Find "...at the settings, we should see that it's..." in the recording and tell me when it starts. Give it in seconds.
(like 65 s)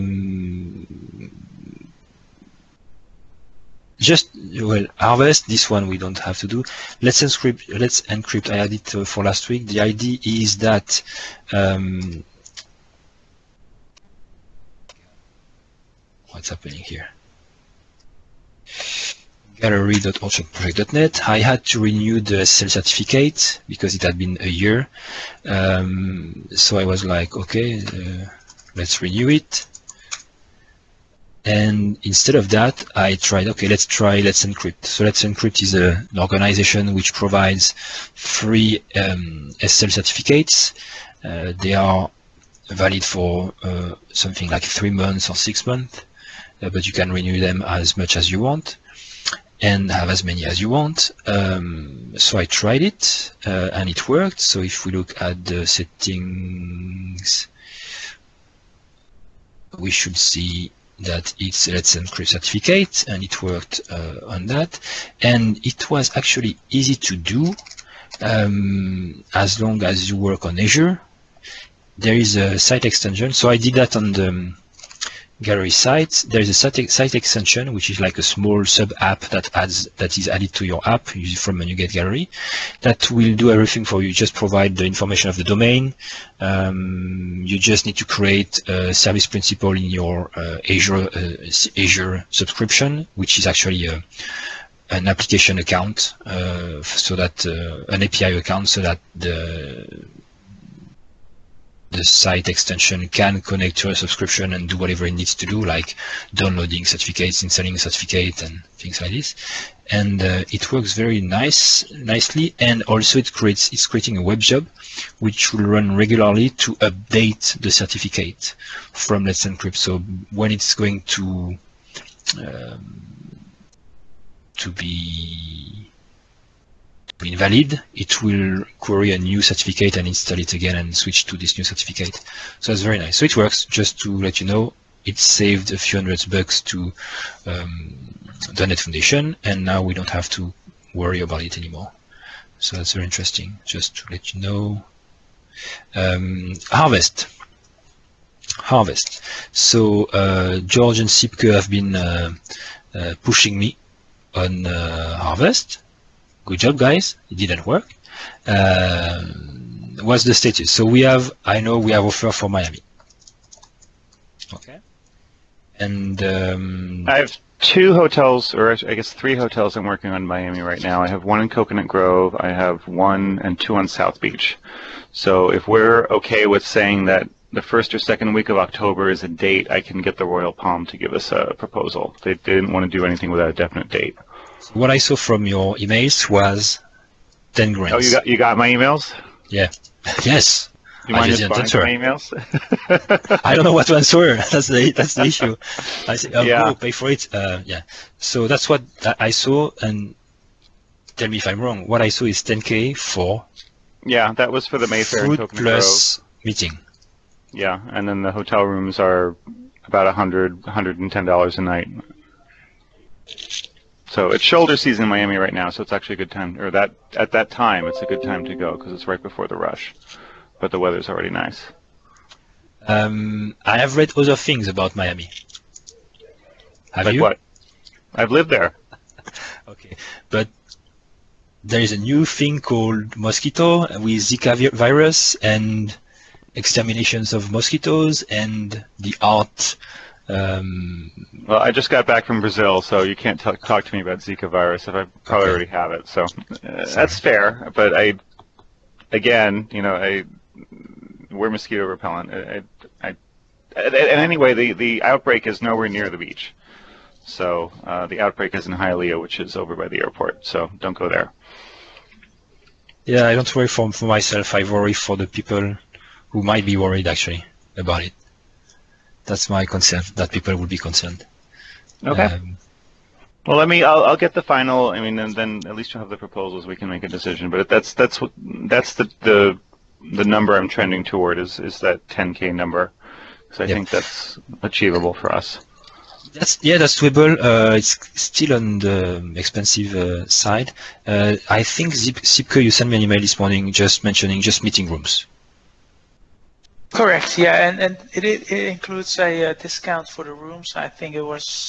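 55 s.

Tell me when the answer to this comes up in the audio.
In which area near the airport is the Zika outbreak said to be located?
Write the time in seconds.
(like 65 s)
258 s.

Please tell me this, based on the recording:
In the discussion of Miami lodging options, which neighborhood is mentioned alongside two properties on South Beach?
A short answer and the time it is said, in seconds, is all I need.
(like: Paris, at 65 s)
Coconut Grove, at 171 s.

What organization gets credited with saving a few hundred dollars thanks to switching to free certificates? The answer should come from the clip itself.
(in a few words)
.NET Foundation.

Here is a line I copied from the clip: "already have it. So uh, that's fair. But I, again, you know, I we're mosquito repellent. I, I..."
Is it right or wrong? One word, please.
right.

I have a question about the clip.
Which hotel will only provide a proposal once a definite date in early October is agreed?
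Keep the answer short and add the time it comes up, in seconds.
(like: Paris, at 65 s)
Royal Palm, at 180 s.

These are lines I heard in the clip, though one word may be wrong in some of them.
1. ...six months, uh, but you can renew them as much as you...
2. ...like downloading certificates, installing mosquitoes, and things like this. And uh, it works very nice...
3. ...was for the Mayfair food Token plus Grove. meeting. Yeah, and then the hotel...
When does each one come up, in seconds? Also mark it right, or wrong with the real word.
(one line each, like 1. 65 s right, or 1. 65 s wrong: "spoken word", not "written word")
1. 45 s right
2. 105 s wrong: "certificates", not "mosquitoes"
3. 204 s right.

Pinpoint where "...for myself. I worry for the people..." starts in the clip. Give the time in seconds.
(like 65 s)
263 s.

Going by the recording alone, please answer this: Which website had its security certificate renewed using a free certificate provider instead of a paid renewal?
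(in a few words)
gallery.orchardproject.net.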